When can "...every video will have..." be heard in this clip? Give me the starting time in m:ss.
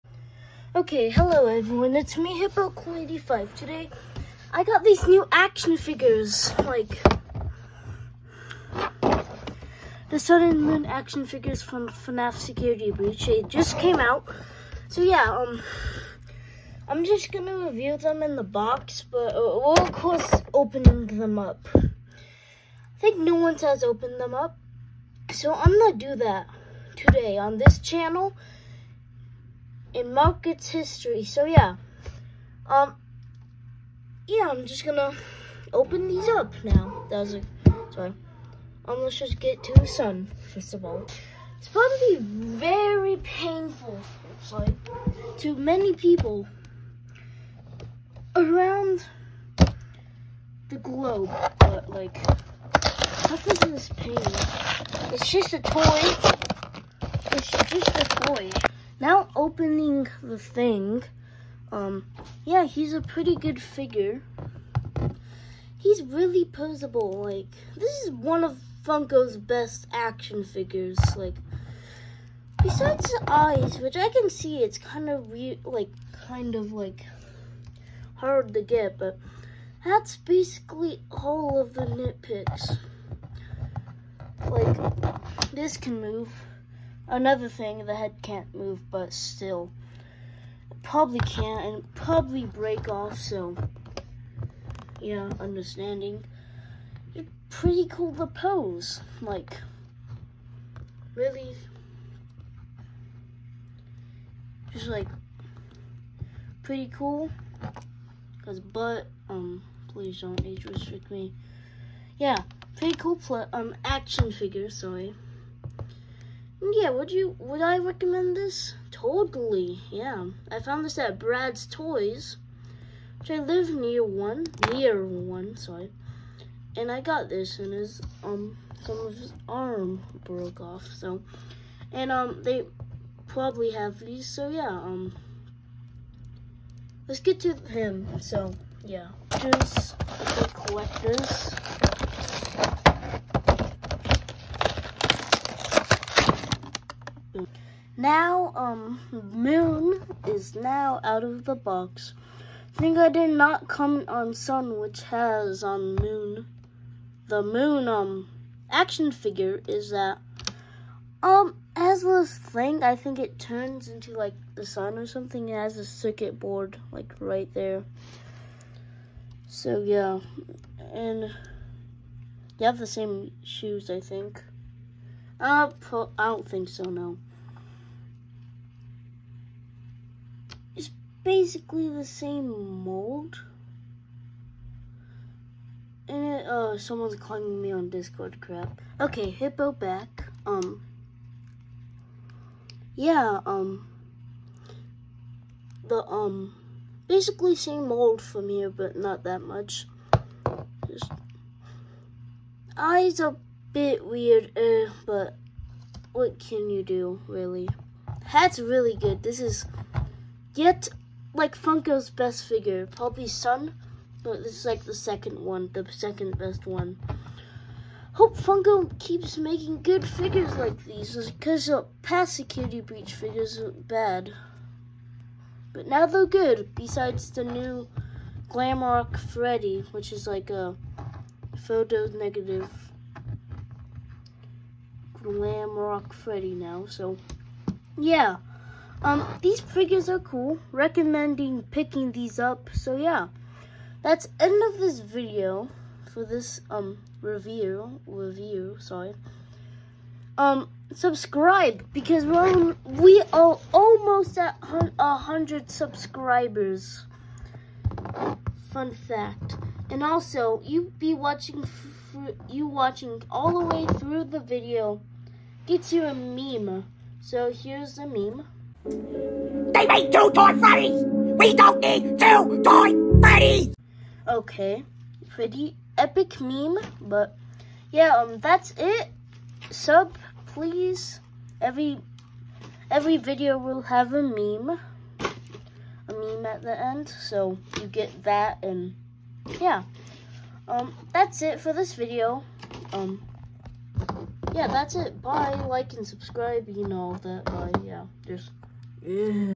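4:42.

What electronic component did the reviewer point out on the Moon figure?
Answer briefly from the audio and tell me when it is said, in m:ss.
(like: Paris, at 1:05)
Circuit board, at 2:45.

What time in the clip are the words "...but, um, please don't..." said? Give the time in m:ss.
1:48.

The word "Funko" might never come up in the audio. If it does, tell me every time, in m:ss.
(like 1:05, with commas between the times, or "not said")
1:08, 3:31, 3:38.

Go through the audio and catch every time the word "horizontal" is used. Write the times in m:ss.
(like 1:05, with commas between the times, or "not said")
not said.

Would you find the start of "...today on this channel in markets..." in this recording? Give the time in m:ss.
0:26.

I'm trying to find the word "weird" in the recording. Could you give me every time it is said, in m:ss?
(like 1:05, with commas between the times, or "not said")
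1:15, 3:24.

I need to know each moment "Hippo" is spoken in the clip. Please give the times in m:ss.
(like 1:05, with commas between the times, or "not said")
0:02, 3:09.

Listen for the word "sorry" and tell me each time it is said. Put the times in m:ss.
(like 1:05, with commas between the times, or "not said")
0:37, 0:44, 1:54, 2:05, 4:08.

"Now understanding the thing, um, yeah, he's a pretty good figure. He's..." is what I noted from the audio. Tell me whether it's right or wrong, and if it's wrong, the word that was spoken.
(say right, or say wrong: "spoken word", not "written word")
wrong: "opening", not "understanding".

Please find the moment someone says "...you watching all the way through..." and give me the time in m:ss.
4:22.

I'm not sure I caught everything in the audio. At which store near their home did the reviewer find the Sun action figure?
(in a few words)
Brad's Toys.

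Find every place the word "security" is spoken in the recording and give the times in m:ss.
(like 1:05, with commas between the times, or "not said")
0:12, 3:42.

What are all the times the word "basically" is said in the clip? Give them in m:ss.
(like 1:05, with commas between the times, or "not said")
1:20, 3:01, 3:17.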